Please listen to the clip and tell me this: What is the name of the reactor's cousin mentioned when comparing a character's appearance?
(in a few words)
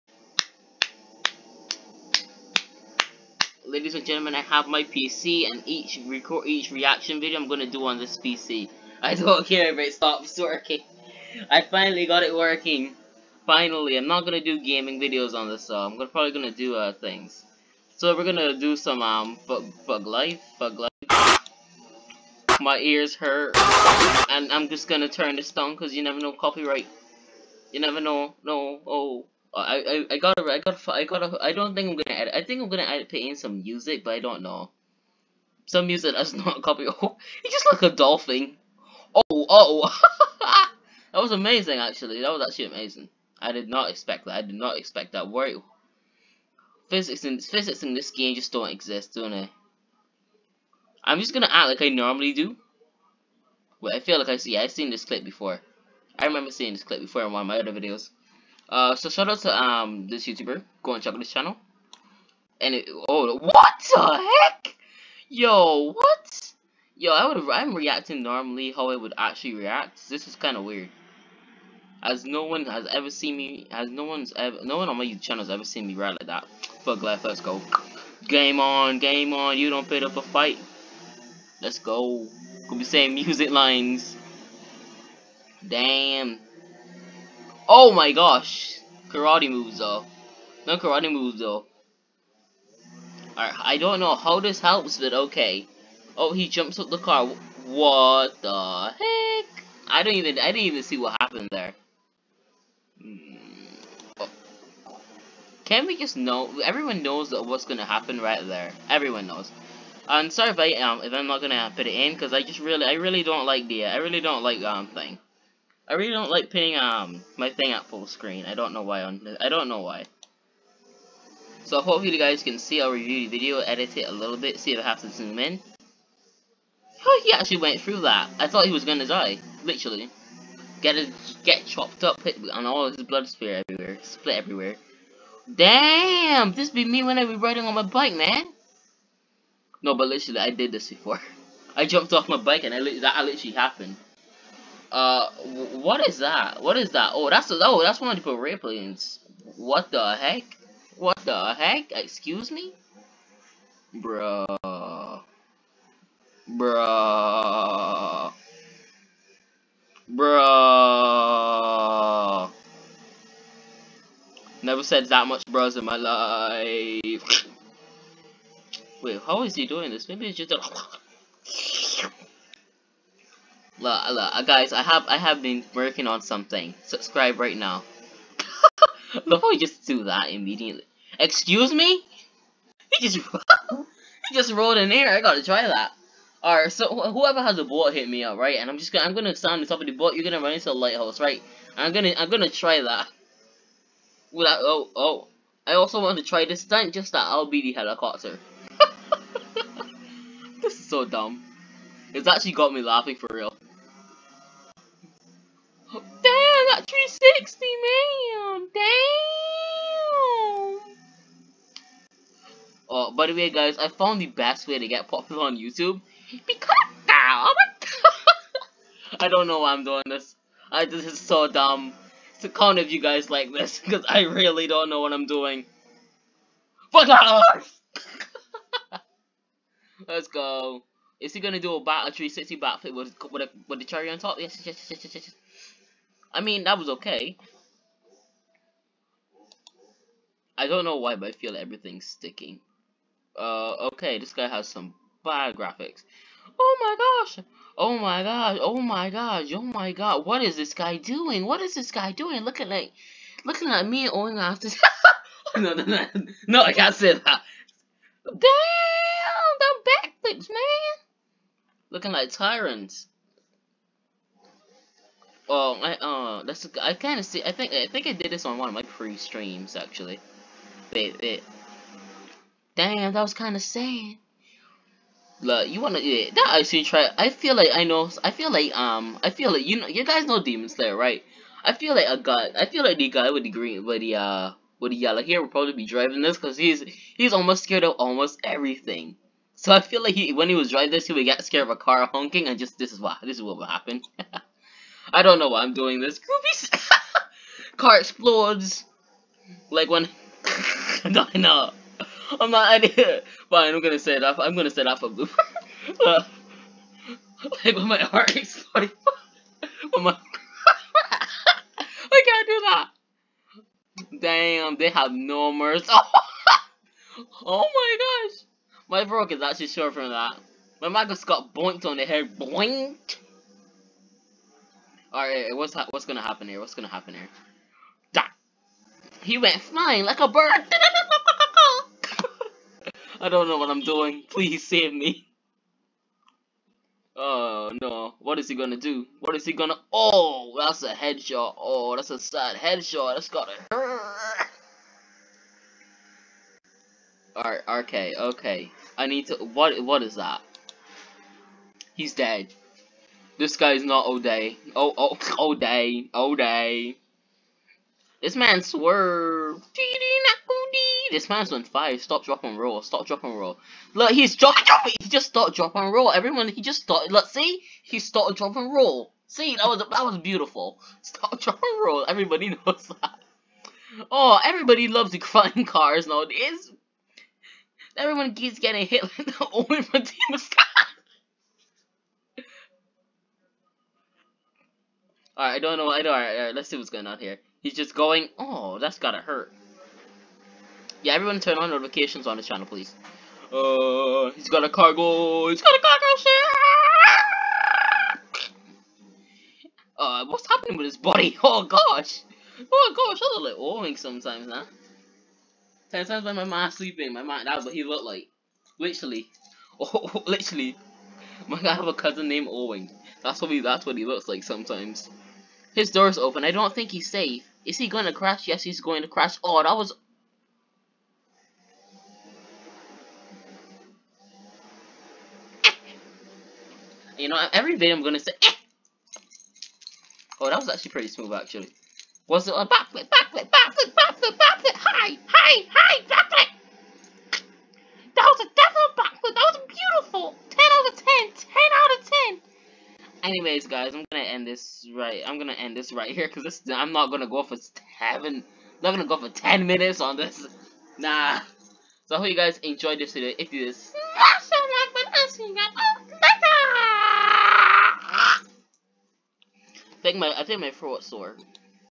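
Owing.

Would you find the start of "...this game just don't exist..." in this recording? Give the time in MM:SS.
00:47.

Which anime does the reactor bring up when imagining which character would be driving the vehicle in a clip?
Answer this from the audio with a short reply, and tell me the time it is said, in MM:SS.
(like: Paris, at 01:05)
Demon Slayer, at 04:40.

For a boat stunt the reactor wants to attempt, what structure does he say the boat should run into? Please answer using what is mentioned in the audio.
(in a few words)
lighthouse.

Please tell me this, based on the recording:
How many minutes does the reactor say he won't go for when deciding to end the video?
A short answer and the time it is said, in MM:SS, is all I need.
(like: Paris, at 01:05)
10, at 07:29.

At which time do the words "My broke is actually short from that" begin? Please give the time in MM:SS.
05:18.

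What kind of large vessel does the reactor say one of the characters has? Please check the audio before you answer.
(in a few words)
cargo ship.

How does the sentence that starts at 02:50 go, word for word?
Maybe it's just a Look, look, uh, guys, I have I have been working on something.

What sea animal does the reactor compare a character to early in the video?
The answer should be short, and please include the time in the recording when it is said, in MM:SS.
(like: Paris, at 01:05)
dolphin, at 00:37.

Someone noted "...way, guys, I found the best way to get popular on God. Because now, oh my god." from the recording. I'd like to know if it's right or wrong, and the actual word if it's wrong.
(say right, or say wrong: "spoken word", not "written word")
wrong: "YouTube", not "God".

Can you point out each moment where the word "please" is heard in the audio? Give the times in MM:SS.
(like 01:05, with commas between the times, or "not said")
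05:34, 06:32.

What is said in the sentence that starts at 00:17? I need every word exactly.
So we're gonna do some um bug thug life, thug life.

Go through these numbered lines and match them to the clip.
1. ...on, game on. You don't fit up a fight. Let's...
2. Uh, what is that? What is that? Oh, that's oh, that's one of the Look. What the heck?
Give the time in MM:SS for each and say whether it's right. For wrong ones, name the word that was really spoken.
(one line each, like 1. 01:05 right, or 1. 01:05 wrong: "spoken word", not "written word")
1. 01:18 right
2. 02:24 wrong: "Paraplans", not "Look".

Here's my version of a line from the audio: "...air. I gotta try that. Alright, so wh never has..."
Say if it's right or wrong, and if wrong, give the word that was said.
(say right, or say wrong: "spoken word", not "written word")
wrong: "whoever", not "never".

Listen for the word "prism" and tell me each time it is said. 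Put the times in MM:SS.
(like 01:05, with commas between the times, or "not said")
not said.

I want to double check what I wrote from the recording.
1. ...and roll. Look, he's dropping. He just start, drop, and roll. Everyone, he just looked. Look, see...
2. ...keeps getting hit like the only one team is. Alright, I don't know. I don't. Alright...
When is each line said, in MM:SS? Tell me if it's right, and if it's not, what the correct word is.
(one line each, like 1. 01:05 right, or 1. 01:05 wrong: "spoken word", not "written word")
1. 06:03 wrong: "started", not "looked"
2. 06:18 right.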